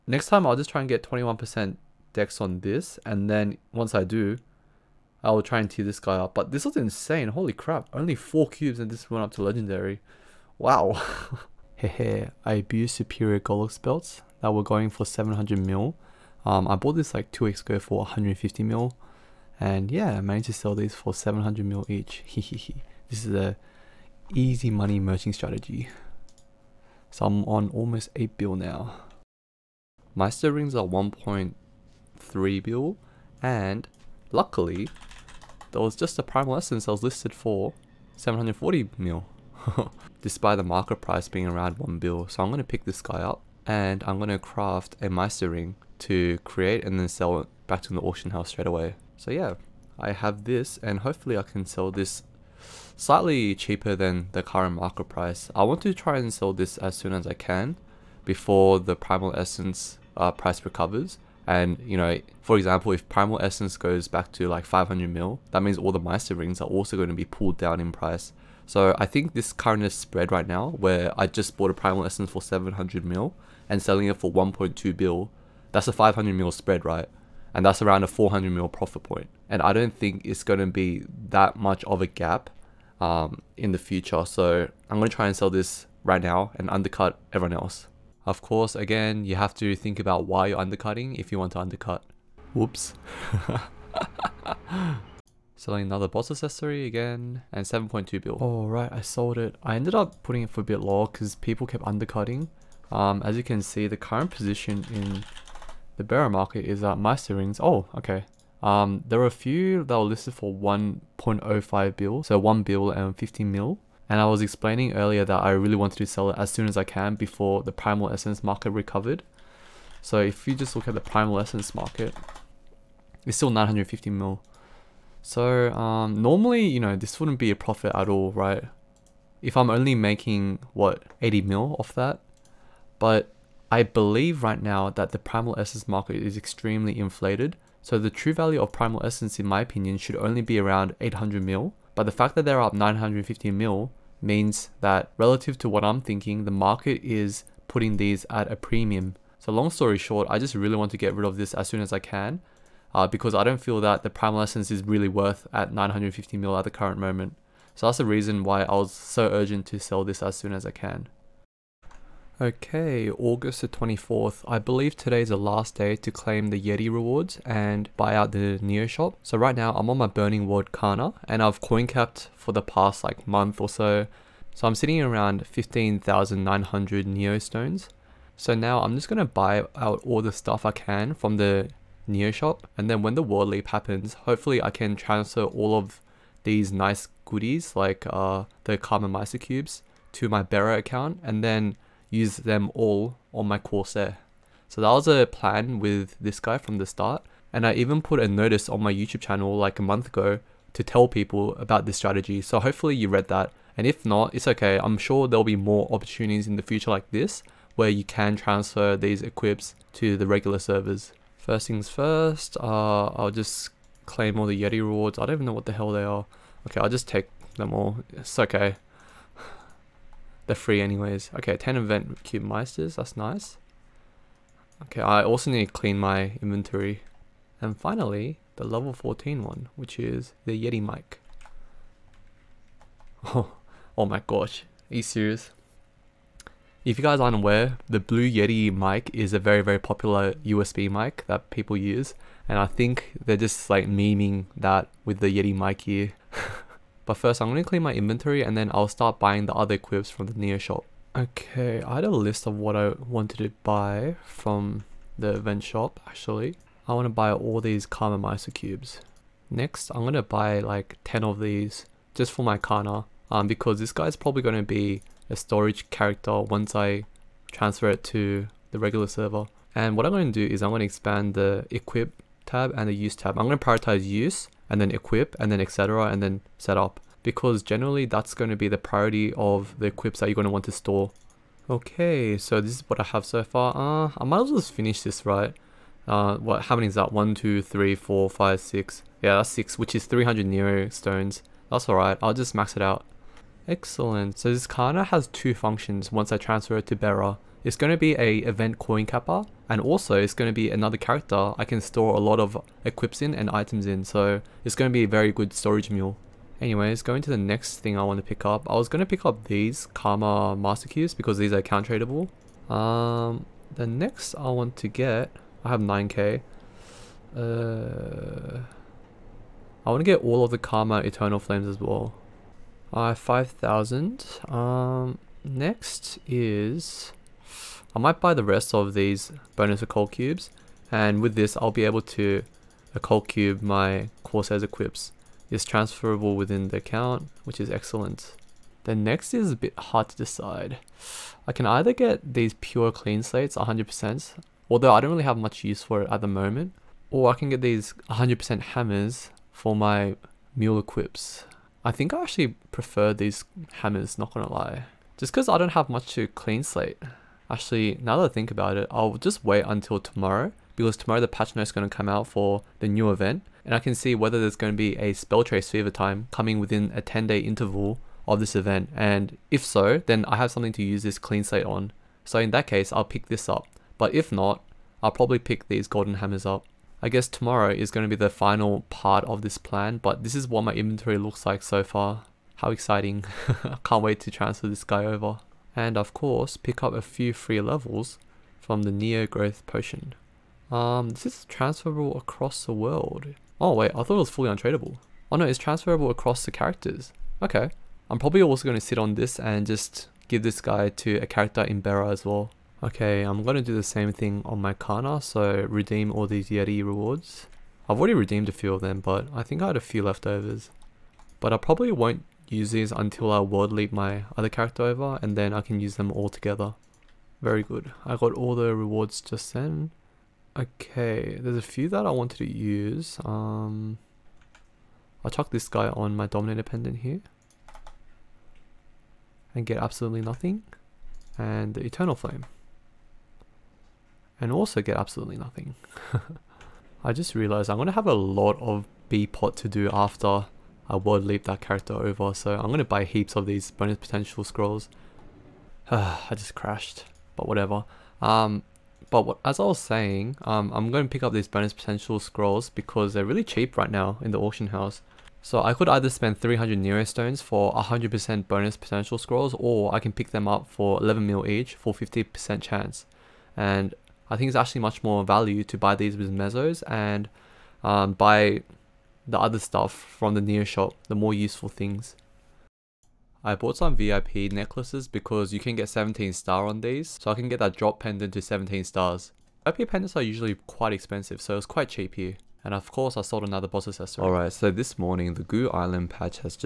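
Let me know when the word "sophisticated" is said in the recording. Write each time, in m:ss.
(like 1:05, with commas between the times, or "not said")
not said.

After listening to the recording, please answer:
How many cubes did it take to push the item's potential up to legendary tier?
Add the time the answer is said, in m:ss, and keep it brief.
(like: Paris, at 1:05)
4, at 0:07.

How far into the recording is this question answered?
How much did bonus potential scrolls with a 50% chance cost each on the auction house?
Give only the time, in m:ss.
7:41.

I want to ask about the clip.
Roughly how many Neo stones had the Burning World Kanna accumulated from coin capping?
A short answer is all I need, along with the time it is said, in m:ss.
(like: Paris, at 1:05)
15,900, at 2:55.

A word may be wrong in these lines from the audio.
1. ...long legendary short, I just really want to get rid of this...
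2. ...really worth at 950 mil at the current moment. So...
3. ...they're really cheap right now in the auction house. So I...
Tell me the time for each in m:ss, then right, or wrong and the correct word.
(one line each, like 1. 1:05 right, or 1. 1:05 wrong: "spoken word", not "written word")
1. 2:29 wrong: "story", not "legendary"
2. 2:34 right
3. 7:33 right.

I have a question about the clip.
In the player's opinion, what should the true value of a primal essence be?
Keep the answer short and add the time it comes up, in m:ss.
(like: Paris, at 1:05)
800 mil, at 2:20.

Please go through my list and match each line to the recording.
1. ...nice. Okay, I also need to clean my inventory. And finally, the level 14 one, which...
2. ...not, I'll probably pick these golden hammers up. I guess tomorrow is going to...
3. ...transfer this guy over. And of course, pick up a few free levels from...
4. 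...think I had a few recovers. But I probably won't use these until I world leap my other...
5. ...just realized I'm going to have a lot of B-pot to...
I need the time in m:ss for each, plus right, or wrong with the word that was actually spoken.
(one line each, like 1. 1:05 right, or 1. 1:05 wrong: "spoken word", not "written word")
1. 3:43 right
2. 6:14 right
3. 6:24 right
4. 6:49 wrong: "leftovers", not "recovers"
5. 7:17 right.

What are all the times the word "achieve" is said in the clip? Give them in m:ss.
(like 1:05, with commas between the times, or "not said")
not said.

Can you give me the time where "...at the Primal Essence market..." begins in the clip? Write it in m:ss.
2:00.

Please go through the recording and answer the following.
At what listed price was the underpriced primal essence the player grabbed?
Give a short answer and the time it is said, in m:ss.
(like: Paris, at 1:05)
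740 mil, at 0:38.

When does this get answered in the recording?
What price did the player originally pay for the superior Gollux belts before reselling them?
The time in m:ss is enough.
0:17.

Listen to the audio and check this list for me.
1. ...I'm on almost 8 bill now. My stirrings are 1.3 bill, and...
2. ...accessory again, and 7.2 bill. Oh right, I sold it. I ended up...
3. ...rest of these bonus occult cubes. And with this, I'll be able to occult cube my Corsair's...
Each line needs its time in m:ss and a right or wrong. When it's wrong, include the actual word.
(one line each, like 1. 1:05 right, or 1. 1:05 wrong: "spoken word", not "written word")
1. 0:27 right
2. 1:36 right
3. 5:28 right.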